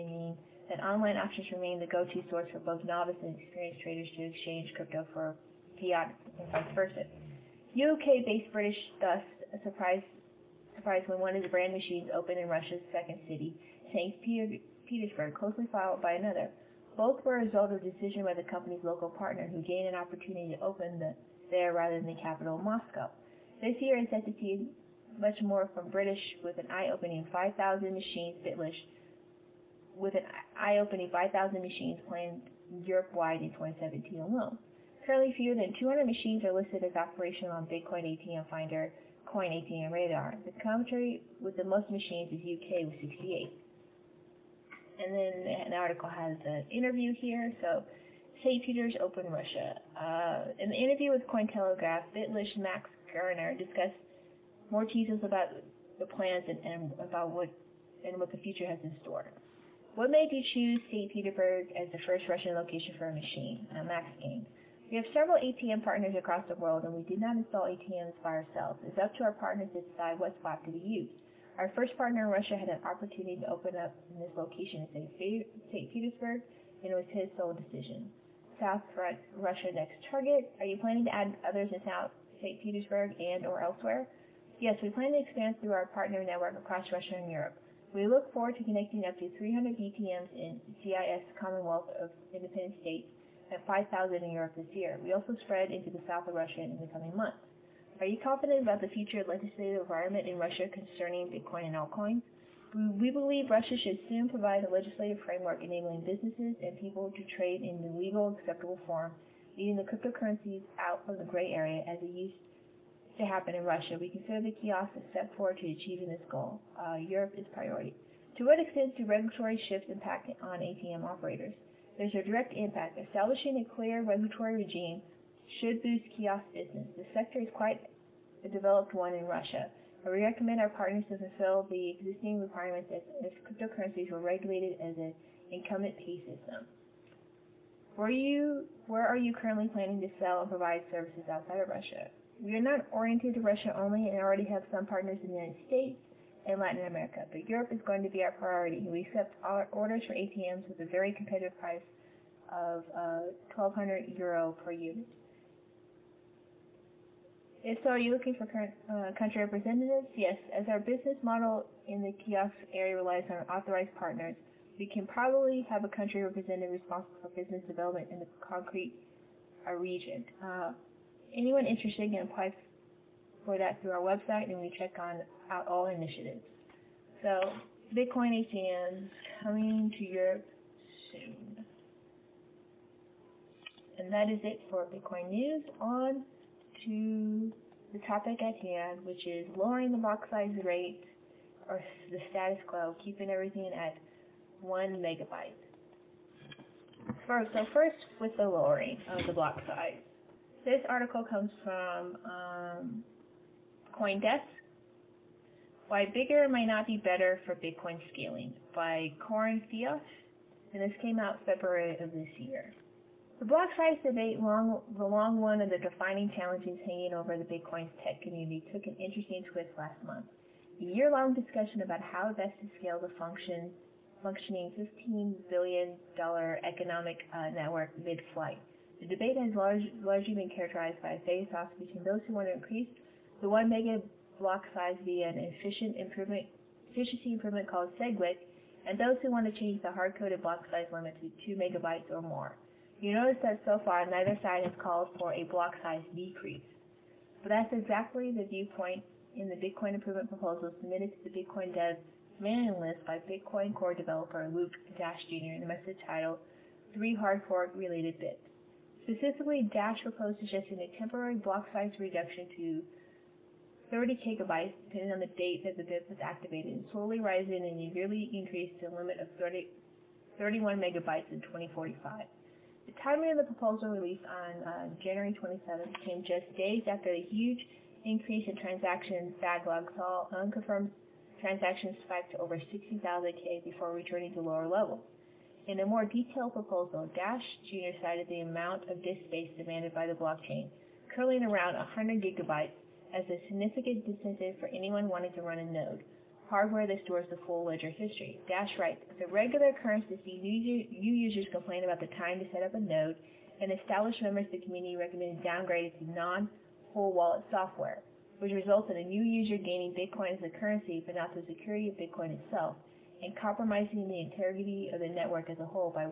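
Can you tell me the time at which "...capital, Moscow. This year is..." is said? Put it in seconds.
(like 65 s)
22 s.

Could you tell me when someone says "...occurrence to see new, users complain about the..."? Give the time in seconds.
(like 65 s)
299 s.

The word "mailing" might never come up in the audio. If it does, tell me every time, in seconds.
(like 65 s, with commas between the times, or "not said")
252 s.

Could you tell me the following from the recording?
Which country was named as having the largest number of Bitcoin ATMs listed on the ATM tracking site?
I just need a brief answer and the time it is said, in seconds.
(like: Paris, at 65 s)
UK, at 42 s.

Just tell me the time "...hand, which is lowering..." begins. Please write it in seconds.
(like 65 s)
188 s.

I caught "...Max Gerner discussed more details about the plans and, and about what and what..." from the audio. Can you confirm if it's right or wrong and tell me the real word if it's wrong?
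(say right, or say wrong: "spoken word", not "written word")
right.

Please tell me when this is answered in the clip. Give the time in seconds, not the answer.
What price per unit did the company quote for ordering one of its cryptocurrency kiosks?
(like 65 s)
153 s.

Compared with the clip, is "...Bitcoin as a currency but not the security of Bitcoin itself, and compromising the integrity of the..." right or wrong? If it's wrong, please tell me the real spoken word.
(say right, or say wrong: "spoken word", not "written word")
right.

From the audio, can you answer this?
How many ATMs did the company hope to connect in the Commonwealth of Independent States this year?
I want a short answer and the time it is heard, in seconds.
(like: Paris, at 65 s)
300, at 89 s.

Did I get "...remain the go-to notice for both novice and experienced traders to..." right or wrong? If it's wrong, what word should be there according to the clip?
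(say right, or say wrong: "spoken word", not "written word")
wrong: "source", not "notice".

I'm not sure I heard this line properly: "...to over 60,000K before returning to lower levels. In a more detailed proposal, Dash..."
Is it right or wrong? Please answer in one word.
right.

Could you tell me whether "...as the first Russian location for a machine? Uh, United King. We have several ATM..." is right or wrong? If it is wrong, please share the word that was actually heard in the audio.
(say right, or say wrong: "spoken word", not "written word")
wrong: "Max", not "United".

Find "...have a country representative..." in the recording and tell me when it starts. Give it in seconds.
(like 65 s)
165 s.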